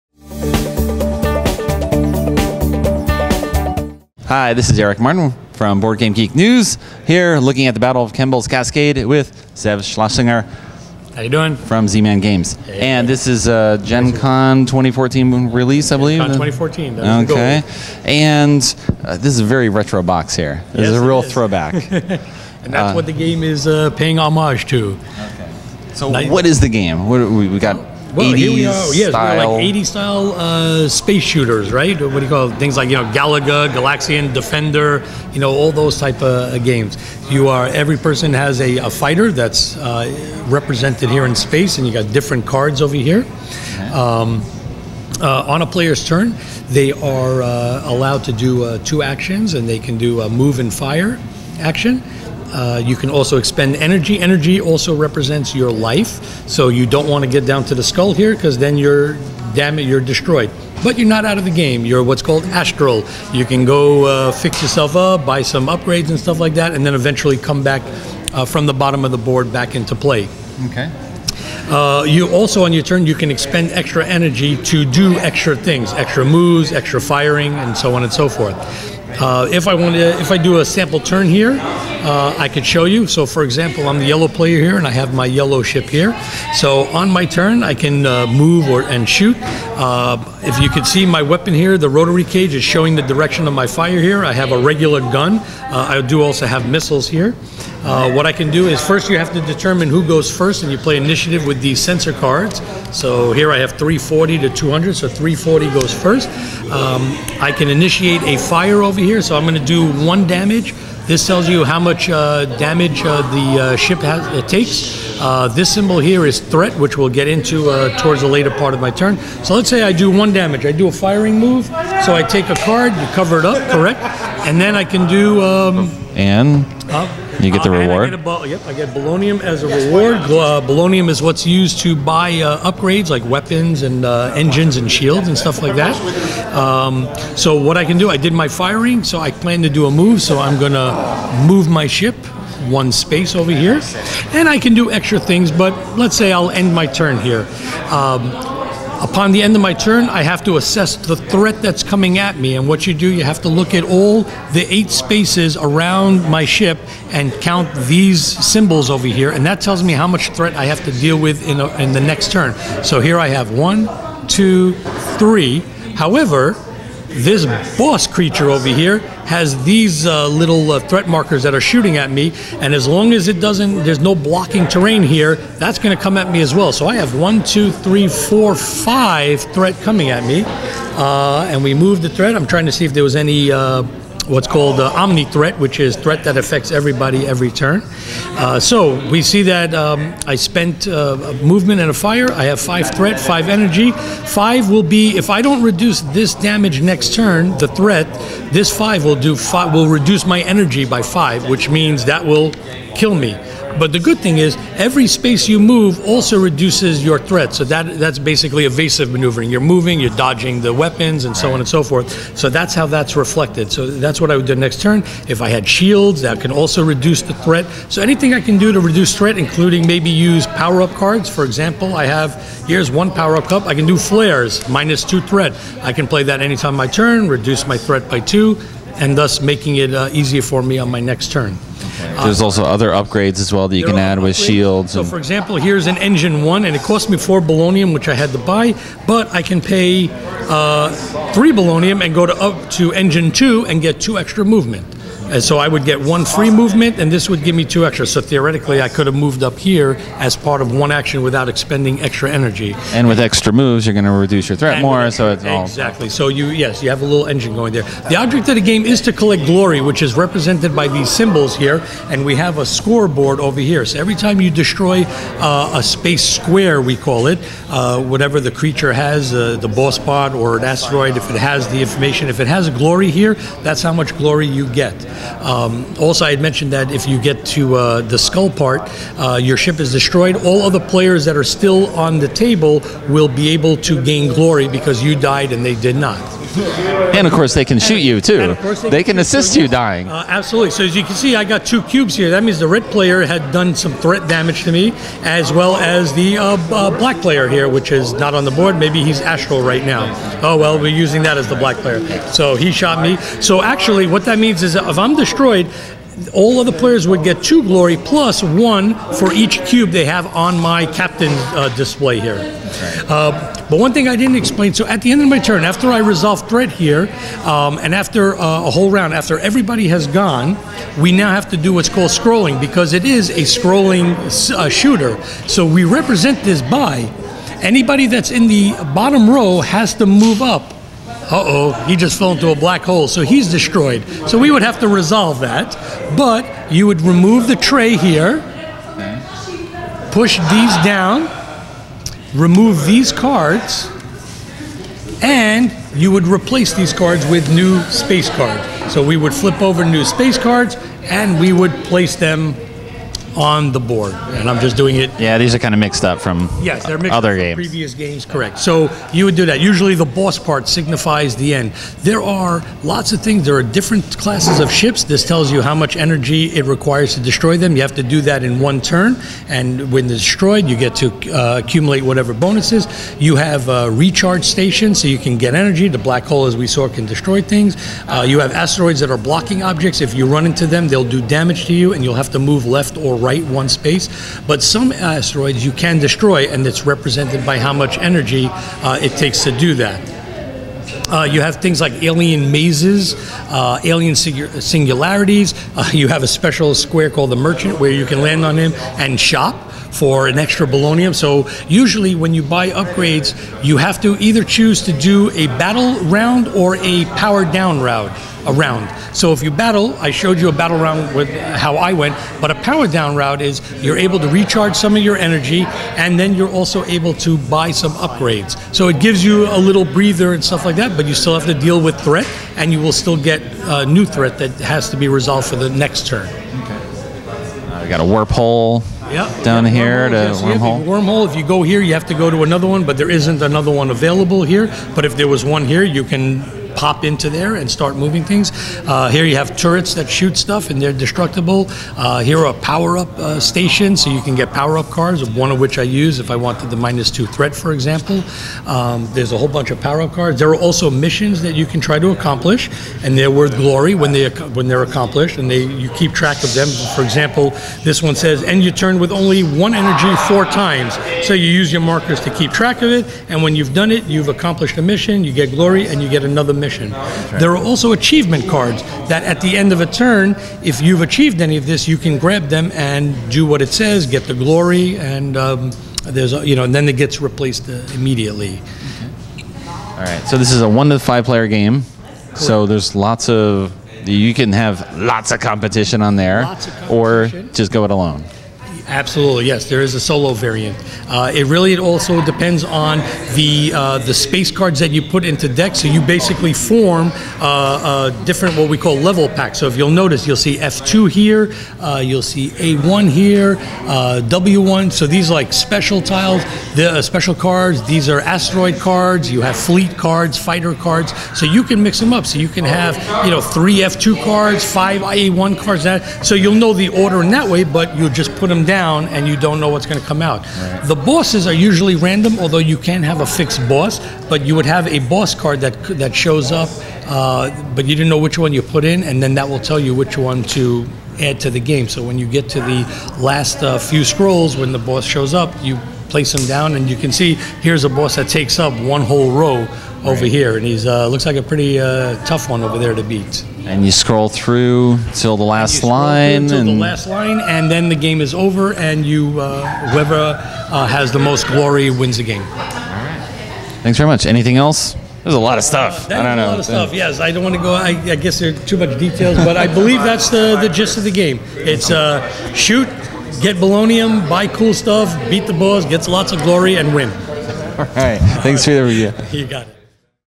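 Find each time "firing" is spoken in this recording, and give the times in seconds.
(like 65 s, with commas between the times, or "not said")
76 s, 120 s, 138 s.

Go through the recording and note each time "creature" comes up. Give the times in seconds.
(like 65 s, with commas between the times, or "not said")
168 s, 268 s.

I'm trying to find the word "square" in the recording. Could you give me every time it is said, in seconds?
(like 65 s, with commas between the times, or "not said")
266 s, 396 s.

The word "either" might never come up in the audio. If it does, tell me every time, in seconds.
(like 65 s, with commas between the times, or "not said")
404 s.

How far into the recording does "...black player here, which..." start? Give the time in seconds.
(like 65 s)
296 s.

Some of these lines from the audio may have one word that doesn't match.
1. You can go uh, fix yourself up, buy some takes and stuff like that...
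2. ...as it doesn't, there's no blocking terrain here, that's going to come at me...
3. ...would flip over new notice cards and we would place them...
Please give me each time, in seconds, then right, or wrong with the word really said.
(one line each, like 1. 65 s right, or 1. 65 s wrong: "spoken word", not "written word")
1. 63 s wrong: "upgrades", not "takes"
2. 173 s right
3. 349 s wrong: "space", not "notice".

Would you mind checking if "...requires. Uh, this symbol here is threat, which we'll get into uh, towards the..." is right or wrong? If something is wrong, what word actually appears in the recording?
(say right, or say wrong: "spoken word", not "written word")
wrong: "takes", not "requires".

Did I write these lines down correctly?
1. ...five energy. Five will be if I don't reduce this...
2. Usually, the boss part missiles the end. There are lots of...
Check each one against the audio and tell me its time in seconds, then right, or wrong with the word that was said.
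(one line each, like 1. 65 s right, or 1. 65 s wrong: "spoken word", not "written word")
1. 193 s right
2. 359 s wrong: "signifies", not "missiles".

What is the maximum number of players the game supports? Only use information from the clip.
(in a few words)
5.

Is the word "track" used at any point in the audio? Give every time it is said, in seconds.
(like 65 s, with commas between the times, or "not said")
456 s, 462 s.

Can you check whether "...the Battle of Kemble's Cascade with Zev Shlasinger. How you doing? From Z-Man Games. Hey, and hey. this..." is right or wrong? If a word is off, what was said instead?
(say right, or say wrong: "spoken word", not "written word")
right.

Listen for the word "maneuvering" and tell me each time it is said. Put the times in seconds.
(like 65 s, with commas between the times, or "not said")
209 s.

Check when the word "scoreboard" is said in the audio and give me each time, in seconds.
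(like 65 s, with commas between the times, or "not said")
262 s.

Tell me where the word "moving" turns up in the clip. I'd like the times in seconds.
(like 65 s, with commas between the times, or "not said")
209 s, 437 s.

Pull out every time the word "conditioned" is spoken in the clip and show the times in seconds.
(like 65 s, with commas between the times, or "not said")
not said.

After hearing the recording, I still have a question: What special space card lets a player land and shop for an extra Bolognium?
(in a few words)
The Merchant.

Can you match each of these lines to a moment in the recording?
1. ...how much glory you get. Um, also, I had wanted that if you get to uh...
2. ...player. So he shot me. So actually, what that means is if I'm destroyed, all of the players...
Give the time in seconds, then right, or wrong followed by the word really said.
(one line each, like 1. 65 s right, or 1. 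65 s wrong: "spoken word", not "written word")
1. 273 s wrong: "mentioned", not "wanted"
2. 301 s right.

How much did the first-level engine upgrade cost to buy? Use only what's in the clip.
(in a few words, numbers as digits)
4 Bolognium.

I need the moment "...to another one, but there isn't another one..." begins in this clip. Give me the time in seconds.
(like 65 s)
432 s.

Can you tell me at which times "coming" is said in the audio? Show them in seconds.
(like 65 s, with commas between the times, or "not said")
151 s, 179 s.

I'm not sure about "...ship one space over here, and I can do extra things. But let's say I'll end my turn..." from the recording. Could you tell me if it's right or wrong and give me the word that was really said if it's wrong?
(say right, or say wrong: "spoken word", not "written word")
right.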